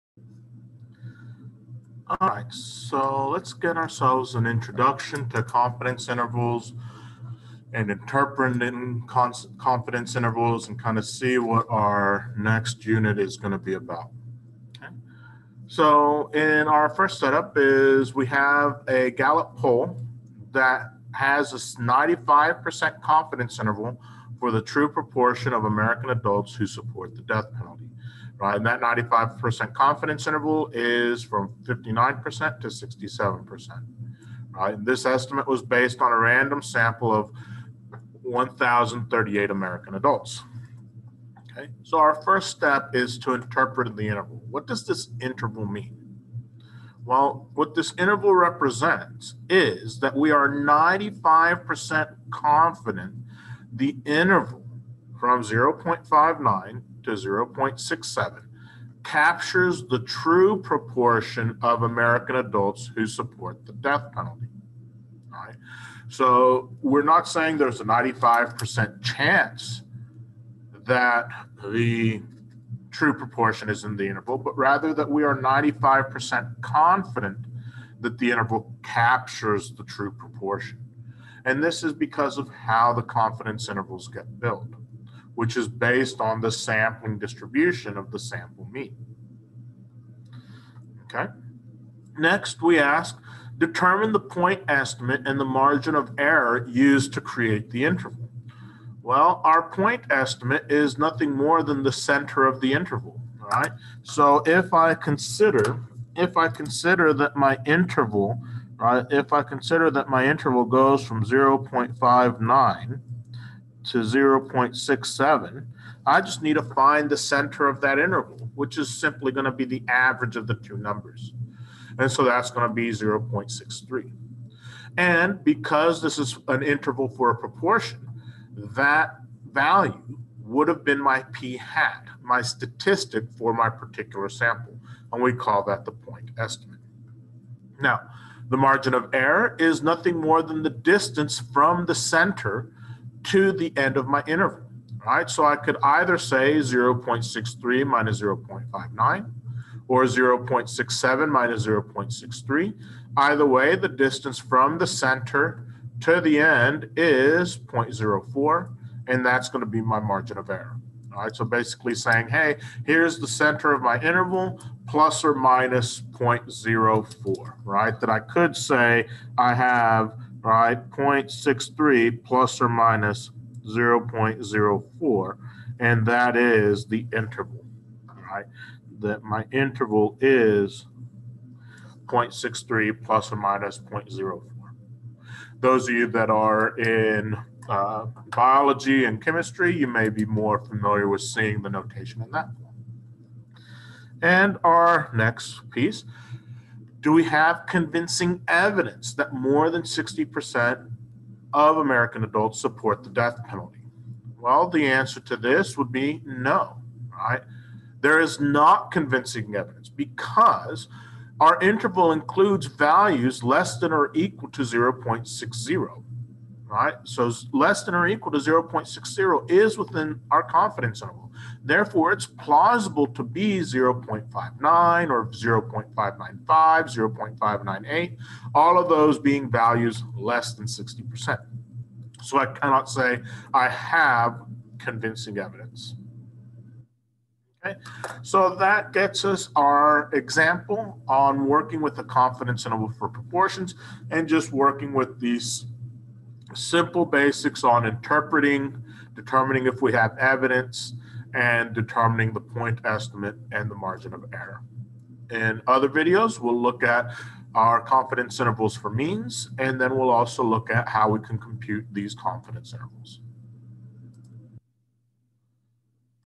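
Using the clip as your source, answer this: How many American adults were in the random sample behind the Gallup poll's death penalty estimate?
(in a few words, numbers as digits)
1,038.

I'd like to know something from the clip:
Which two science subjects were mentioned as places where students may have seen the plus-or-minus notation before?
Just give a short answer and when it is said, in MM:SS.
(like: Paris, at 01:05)
biology and chemistry, at 03:08.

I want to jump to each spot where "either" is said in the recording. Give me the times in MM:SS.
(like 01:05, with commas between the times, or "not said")
02:25, 02:33.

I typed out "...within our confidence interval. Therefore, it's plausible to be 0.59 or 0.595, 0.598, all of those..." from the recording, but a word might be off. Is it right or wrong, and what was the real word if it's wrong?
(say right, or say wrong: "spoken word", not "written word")
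right.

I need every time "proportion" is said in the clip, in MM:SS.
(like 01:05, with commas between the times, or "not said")
00:24, 01:00, 01:13, 01:20, 02:07, 04:03.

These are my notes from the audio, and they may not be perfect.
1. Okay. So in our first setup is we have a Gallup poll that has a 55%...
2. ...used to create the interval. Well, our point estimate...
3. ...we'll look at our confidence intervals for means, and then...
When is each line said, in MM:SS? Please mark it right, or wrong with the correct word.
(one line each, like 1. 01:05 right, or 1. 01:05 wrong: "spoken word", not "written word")
1. 00:14 wrong: "95", not "55"
2. 01:36 right
3. 04:16 right.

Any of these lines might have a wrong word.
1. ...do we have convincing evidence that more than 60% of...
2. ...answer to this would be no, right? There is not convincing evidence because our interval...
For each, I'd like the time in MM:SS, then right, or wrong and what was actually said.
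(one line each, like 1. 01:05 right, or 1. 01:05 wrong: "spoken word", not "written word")
1. 03:17 right
2. 03:24 right.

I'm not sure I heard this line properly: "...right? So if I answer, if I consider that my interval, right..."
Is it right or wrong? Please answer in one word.
wrong.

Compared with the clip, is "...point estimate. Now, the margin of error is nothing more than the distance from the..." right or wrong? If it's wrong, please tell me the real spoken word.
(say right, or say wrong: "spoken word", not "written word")
right.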